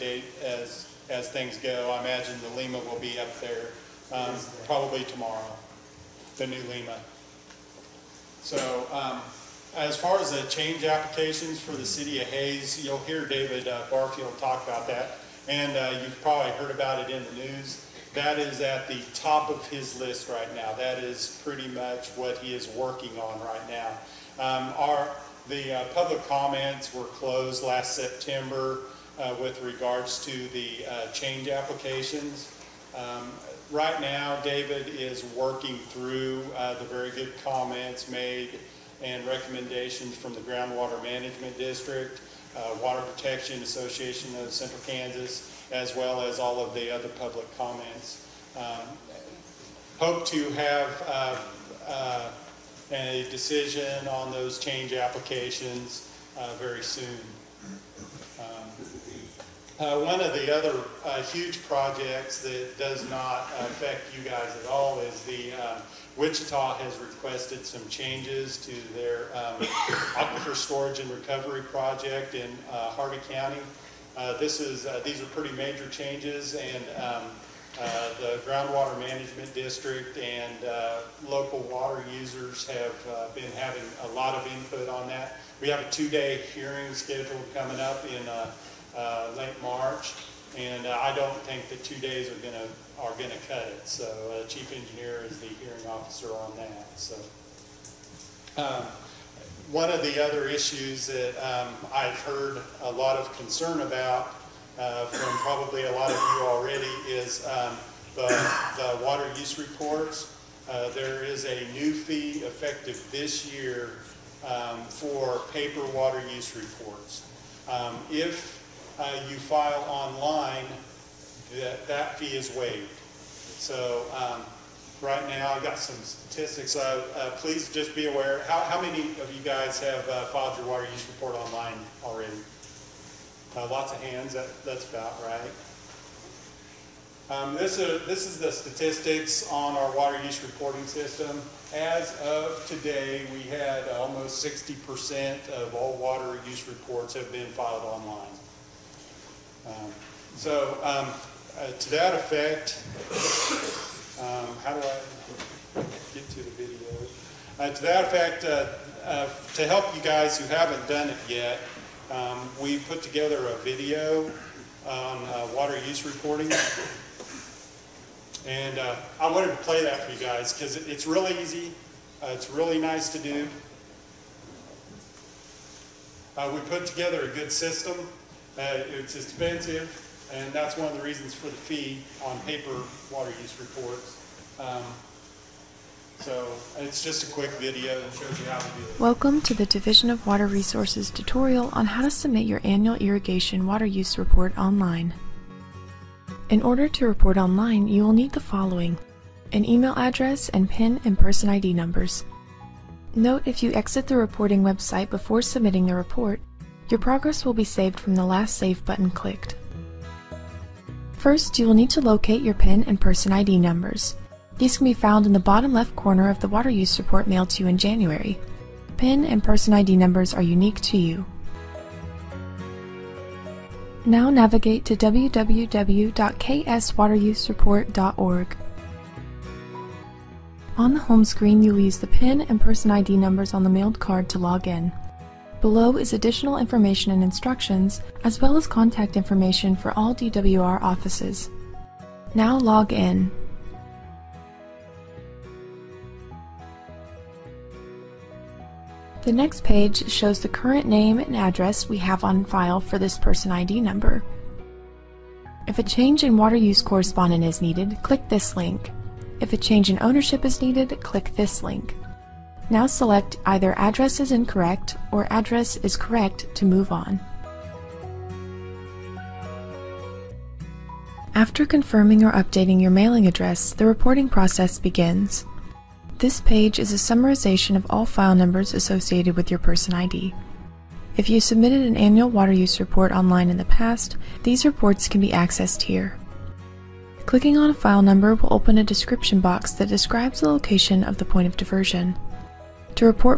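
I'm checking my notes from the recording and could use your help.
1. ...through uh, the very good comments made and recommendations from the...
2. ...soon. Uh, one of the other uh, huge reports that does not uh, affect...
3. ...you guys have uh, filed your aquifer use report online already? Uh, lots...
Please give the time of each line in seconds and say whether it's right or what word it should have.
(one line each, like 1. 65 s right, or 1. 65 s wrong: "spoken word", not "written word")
1. 35 s right
2. 56 s wrong: "projects", not "reports"
3. 129 s wrong: "water", not "aquifer".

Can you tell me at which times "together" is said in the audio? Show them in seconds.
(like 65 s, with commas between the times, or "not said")
163 s, 176 s.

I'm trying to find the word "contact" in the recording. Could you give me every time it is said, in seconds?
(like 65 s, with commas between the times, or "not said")
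238 s.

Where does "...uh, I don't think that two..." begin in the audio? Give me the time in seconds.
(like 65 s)
90 s.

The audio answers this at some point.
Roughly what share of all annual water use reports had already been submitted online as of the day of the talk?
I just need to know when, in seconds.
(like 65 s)
144 s.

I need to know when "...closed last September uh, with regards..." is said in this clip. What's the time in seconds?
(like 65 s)
27 s.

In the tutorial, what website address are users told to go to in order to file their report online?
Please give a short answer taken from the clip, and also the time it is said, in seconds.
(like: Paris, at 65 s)
www.kswaterusereport.org, at 224 s.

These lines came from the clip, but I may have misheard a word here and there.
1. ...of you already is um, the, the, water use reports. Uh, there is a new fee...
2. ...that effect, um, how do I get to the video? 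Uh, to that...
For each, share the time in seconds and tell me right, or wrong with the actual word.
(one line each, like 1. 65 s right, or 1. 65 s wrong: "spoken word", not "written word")
1. 106 s right
2. 151 s right.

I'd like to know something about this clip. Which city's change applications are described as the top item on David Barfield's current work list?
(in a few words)
Hays.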